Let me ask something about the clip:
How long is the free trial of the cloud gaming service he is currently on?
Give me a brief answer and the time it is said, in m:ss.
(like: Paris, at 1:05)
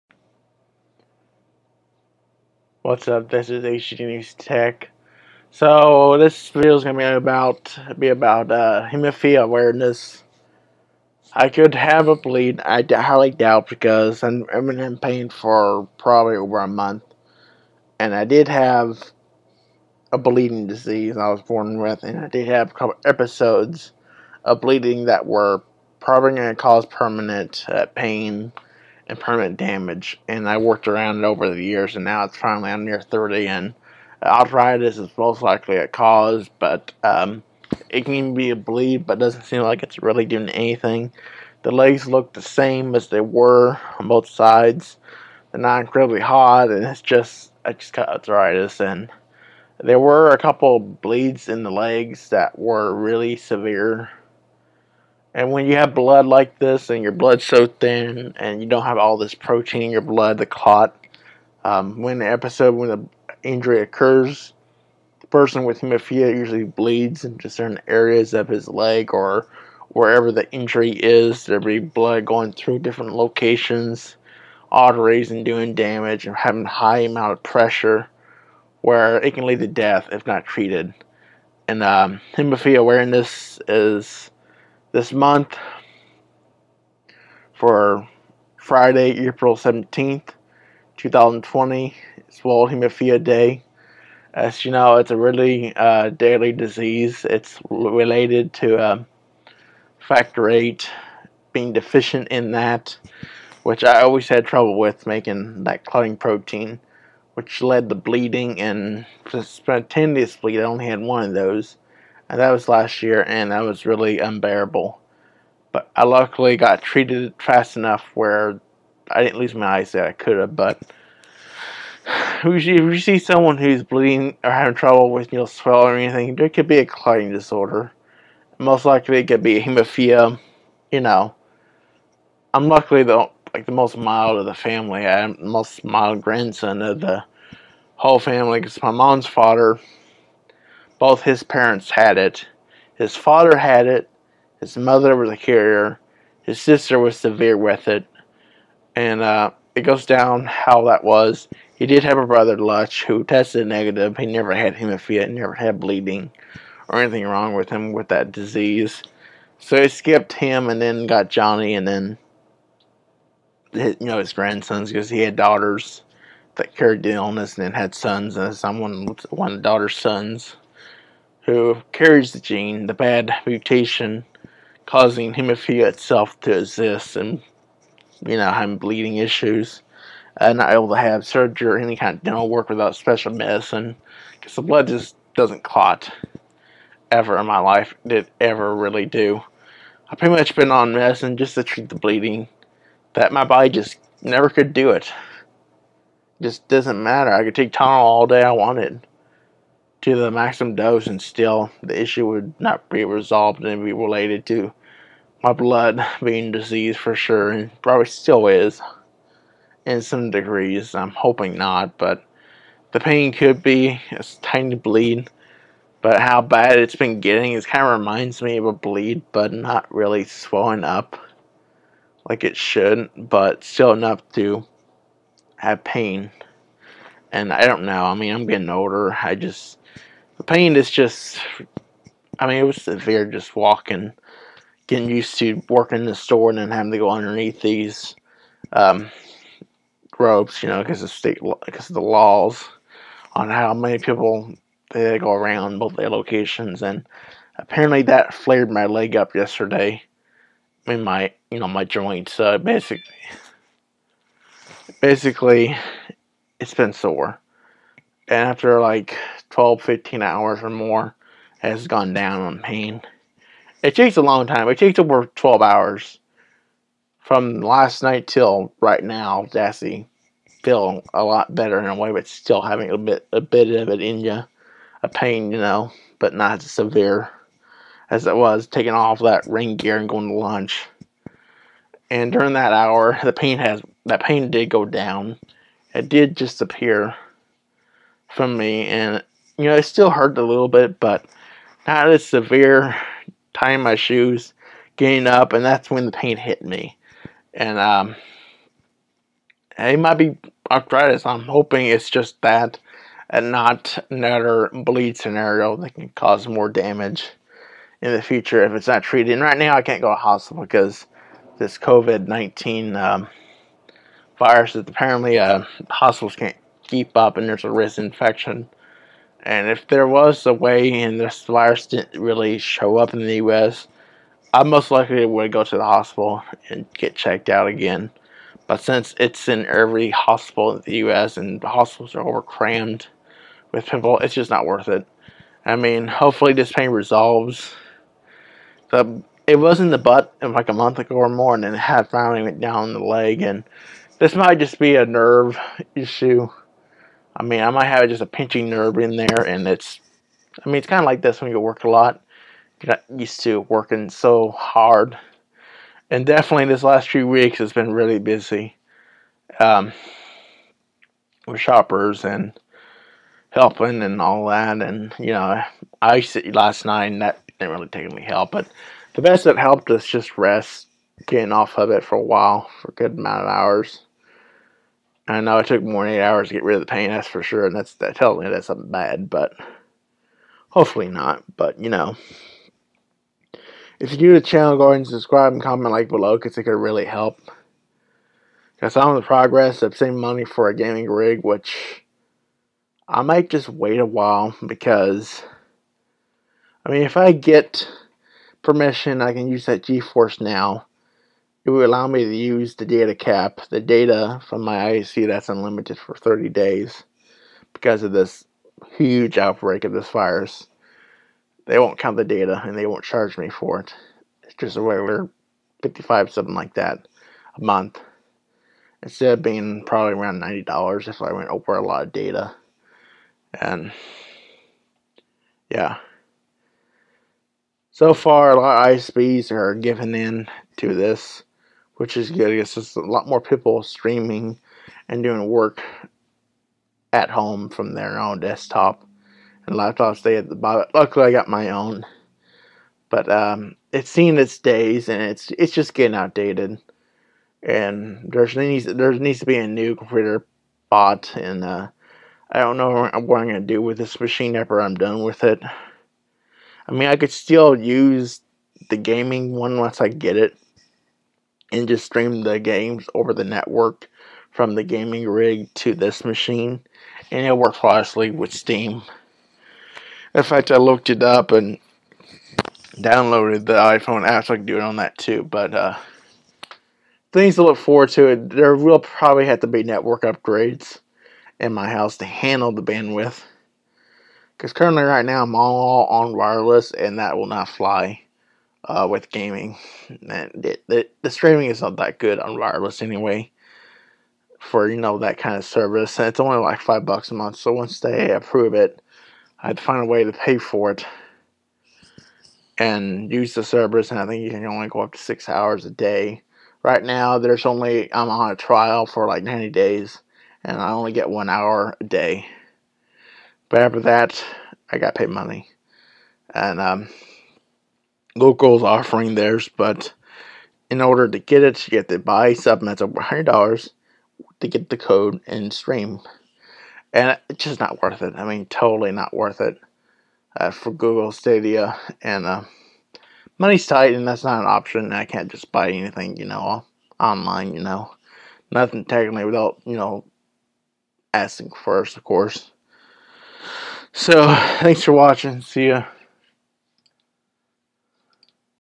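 90 days, at 8:29.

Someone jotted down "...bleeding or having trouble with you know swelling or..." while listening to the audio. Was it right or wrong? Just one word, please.
right.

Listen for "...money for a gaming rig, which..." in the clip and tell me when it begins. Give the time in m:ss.
6:30.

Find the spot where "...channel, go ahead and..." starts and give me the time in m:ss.
6:24.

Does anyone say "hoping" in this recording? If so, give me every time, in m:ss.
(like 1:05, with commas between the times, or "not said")
3:31, 5:01.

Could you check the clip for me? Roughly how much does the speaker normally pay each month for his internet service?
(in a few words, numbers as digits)
$55.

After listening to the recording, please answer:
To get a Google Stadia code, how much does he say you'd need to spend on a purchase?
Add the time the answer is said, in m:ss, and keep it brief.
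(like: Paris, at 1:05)
over $100, at 8:43.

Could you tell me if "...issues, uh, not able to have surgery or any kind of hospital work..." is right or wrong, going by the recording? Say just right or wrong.
wrong.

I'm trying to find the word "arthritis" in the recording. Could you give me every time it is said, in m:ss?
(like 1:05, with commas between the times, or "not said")
0:34, 0:48, 5:00.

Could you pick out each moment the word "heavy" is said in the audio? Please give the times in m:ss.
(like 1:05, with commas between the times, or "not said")
not said.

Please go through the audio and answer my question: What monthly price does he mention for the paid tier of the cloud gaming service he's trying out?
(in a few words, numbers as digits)
$5.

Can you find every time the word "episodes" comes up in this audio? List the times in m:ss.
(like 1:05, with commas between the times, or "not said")
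0:23, 1:02.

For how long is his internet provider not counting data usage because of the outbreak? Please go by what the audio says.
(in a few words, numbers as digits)
30 days.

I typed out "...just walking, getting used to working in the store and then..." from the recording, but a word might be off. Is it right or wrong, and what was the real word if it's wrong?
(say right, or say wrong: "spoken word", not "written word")
right.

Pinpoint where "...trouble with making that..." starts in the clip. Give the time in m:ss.
1:44.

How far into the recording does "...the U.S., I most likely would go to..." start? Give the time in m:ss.
5:23.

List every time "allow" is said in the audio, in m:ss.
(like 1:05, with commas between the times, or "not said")
6:41.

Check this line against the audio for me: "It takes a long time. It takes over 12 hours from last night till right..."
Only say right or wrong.
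right.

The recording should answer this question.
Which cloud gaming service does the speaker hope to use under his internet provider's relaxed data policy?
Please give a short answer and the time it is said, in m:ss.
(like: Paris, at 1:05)
GeForce Now, at 6:39.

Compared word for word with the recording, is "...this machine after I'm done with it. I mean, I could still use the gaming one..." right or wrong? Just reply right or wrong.
right.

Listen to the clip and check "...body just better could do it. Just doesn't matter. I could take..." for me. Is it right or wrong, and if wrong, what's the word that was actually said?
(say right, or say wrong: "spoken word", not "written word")
wrong: "never", not "better".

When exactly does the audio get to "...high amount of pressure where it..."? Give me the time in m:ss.
1:16.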